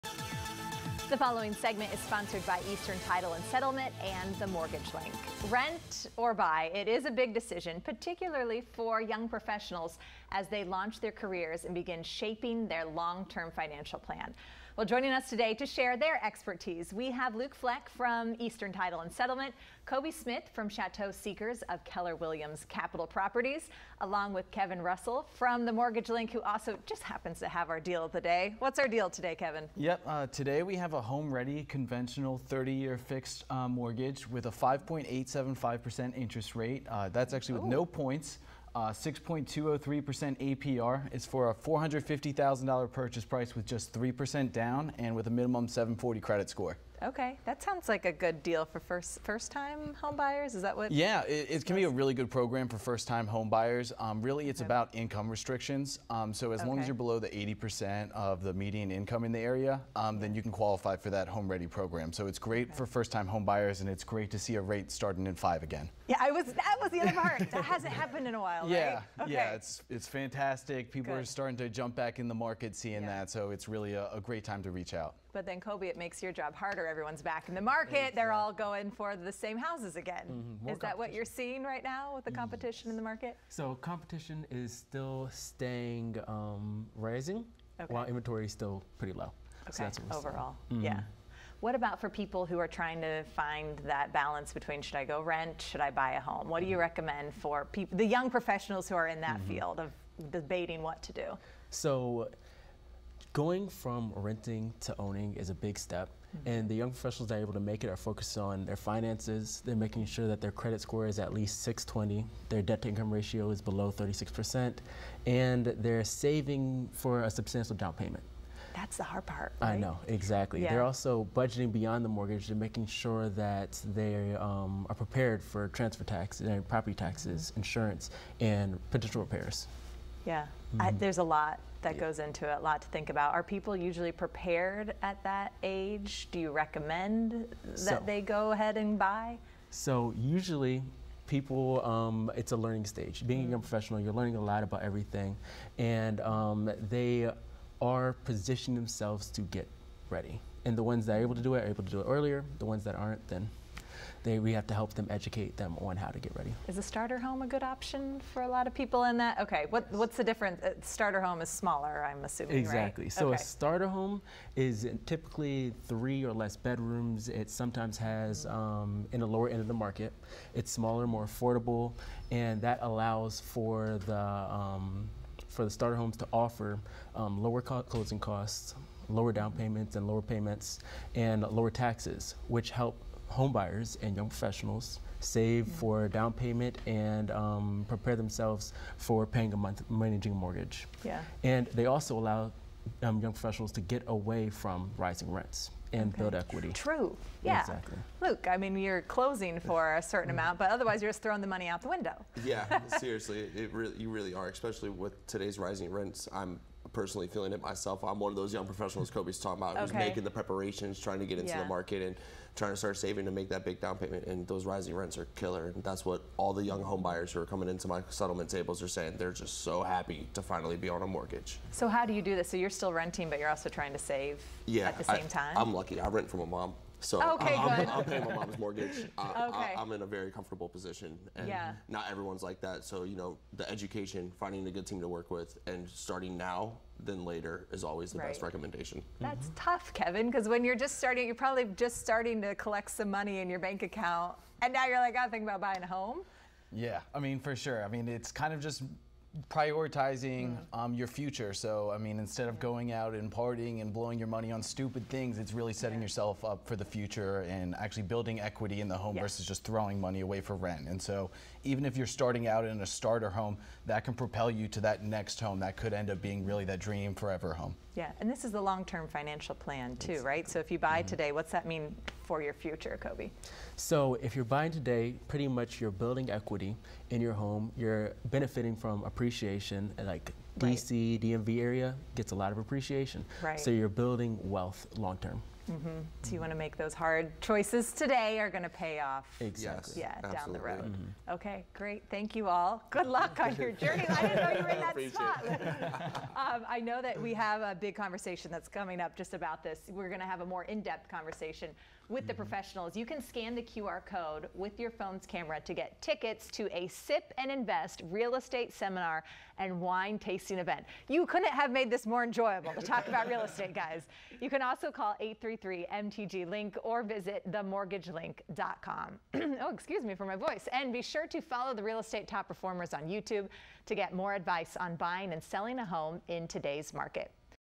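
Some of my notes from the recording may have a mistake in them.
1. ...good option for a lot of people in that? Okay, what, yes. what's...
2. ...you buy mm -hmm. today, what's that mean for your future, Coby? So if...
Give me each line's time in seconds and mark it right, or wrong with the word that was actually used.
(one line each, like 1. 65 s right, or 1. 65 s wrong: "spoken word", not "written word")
1. 157 s right
2. 270 s right.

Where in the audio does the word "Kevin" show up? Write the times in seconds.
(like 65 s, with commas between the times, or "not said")
24 s, 29 s, 239 s.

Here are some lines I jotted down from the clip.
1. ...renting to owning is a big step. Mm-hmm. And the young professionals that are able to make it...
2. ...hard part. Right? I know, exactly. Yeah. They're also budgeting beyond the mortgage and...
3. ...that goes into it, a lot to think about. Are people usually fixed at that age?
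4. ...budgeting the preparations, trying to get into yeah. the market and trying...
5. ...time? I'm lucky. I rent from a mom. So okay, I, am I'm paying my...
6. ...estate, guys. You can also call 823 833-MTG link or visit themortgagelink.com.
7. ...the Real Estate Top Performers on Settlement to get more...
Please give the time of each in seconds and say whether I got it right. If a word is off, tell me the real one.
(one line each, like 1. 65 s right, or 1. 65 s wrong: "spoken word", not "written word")
1. 104 s right
2. 119 s right
3. 131 s wrong: "prepared", not "fixed"
4. 209 s wrong: "making", not "budgeting"
5. 225 s right
6. 313 s wrong: "833", not "823"
7. 321 s wrong: "YouTube", not "Settlement".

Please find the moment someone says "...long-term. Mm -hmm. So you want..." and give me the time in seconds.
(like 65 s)
284 s.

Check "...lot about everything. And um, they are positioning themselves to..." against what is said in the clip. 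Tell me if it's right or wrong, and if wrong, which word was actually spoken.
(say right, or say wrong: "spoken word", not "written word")
right.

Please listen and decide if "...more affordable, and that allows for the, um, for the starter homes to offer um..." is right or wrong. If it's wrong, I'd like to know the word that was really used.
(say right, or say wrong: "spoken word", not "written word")
right.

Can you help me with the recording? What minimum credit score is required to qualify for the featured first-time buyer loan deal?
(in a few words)
740.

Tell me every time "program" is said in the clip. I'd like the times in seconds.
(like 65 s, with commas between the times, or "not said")
52 s, 61 s.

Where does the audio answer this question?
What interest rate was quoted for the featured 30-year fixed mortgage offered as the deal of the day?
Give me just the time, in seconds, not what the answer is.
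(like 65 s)
34 s.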